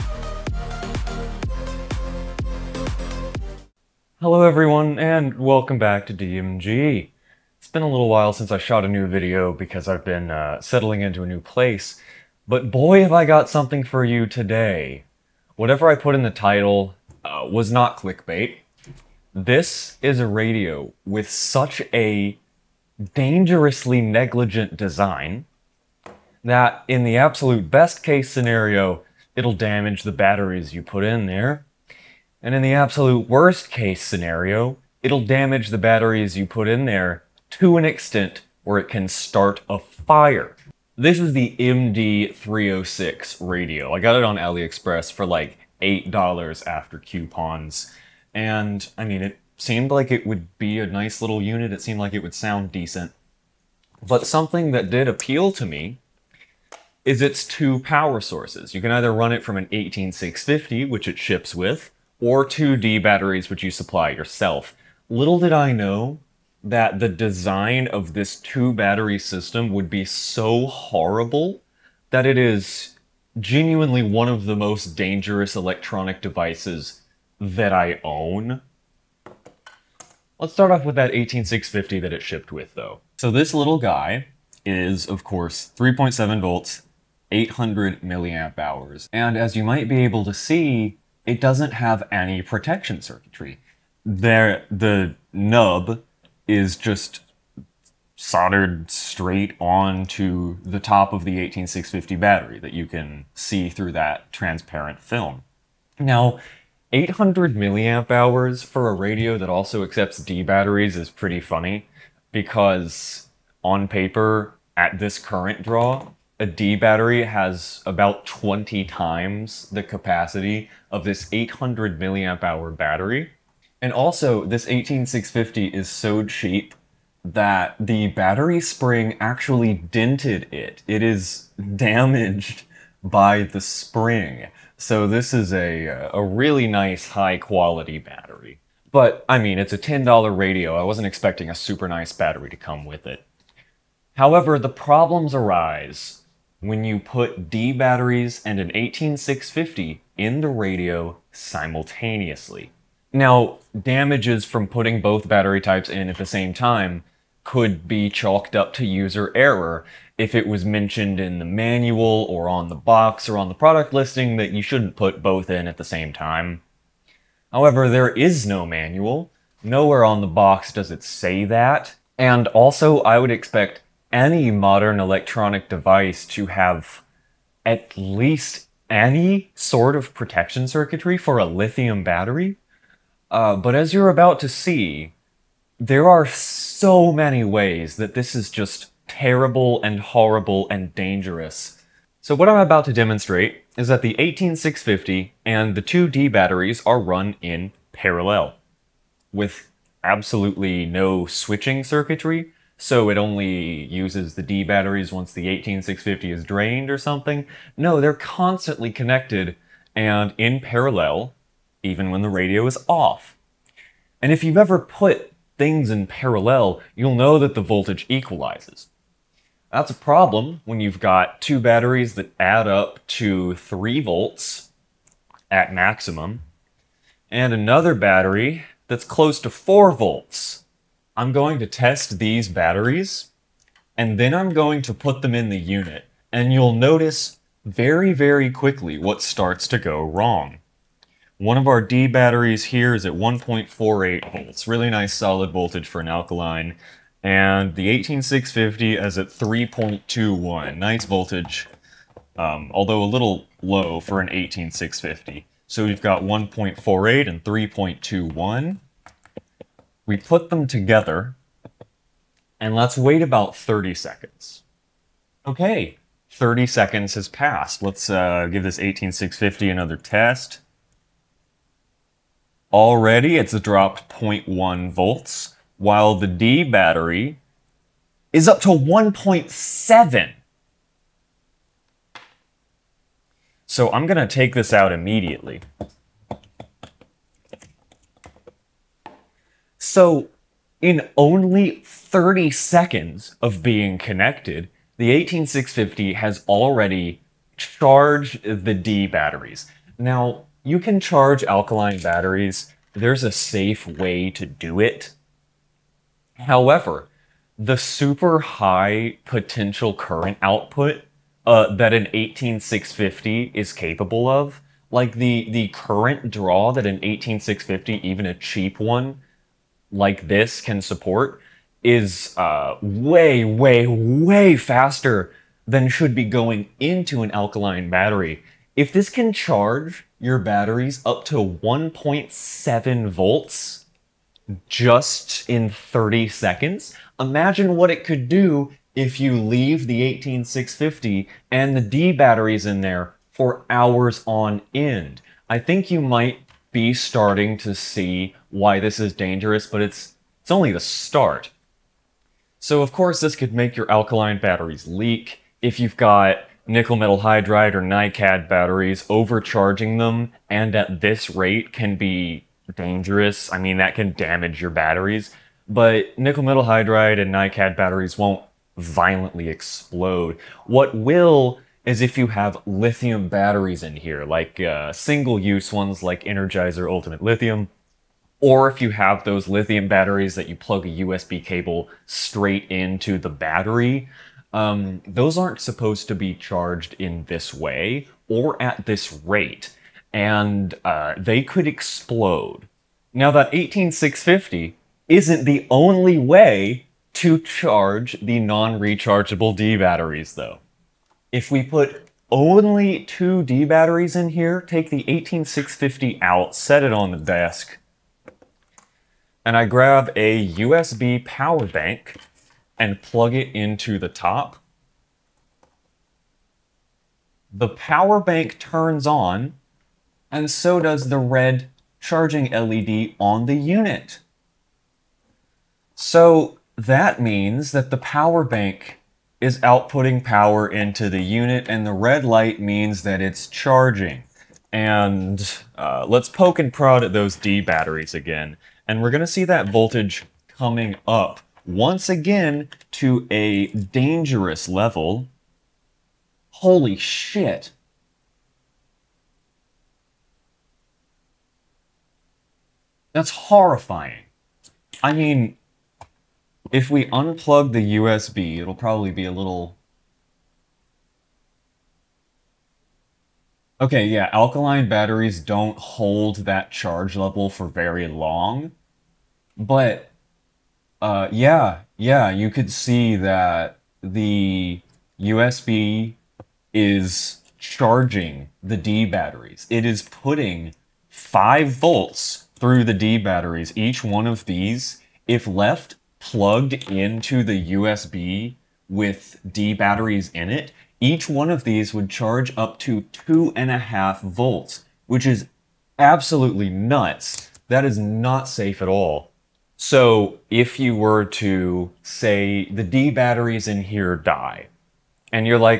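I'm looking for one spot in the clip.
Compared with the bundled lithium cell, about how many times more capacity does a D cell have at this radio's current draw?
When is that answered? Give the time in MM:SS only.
01:58.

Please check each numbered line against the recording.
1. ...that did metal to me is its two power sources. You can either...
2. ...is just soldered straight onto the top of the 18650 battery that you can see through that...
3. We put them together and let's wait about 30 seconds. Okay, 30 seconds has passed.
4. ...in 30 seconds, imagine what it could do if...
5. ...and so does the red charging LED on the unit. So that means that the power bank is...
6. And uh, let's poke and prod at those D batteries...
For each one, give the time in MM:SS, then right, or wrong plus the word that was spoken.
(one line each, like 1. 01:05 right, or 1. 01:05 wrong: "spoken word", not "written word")
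1. 00:54 wrong: "appeal", not "metal"
2. 01:36 right
3. 04:20 right
4. 05:35 right
5. 07:00 right
6. 07:14 right.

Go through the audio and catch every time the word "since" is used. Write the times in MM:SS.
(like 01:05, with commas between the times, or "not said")
00:08.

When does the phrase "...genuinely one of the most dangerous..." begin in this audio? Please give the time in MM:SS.
01:13.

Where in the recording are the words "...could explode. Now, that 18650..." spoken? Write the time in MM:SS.
06:31.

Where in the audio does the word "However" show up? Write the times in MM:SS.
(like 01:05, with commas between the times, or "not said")
02:24, 02:47, 05:06.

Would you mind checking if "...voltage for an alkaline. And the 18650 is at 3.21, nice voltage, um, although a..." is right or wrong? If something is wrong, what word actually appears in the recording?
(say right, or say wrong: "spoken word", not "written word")
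right.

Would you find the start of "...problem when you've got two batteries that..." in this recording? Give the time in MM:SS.
03:39.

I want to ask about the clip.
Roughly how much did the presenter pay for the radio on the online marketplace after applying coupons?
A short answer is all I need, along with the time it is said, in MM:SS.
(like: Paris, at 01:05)
$8, at 00:45.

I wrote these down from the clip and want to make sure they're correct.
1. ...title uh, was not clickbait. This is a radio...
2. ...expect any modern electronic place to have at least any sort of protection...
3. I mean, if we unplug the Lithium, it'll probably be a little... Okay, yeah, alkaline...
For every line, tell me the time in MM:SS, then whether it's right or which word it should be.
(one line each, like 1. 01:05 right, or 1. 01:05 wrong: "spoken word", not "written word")
1. 00:16 right
2. 02:53 wrong: "device", not "place"
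3. 07:35 wrong: "USB", not "Lithium".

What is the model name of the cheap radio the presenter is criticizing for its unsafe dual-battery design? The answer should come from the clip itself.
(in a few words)
MD306.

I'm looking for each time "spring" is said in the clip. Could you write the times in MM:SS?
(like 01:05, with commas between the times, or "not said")
02:08, 02:13.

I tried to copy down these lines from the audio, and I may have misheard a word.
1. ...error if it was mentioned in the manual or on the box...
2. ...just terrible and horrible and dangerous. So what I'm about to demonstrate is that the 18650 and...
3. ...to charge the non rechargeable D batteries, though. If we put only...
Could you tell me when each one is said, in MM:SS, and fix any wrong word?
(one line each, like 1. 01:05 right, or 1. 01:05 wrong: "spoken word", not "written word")
1. 02:39 right
2. 03:08 right
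3. 06:37 right.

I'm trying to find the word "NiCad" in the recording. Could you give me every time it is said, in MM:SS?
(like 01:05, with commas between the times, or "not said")
05:57, 06:07.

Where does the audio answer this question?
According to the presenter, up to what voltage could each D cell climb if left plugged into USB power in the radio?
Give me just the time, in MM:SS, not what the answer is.
08:13.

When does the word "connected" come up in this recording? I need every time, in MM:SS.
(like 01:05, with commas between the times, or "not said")
03:28, 04:53.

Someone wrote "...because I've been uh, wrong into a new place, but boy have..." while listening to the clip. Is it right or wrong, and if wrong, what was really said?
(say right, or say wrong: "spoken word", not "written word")
wrong: "settling", not "wrong".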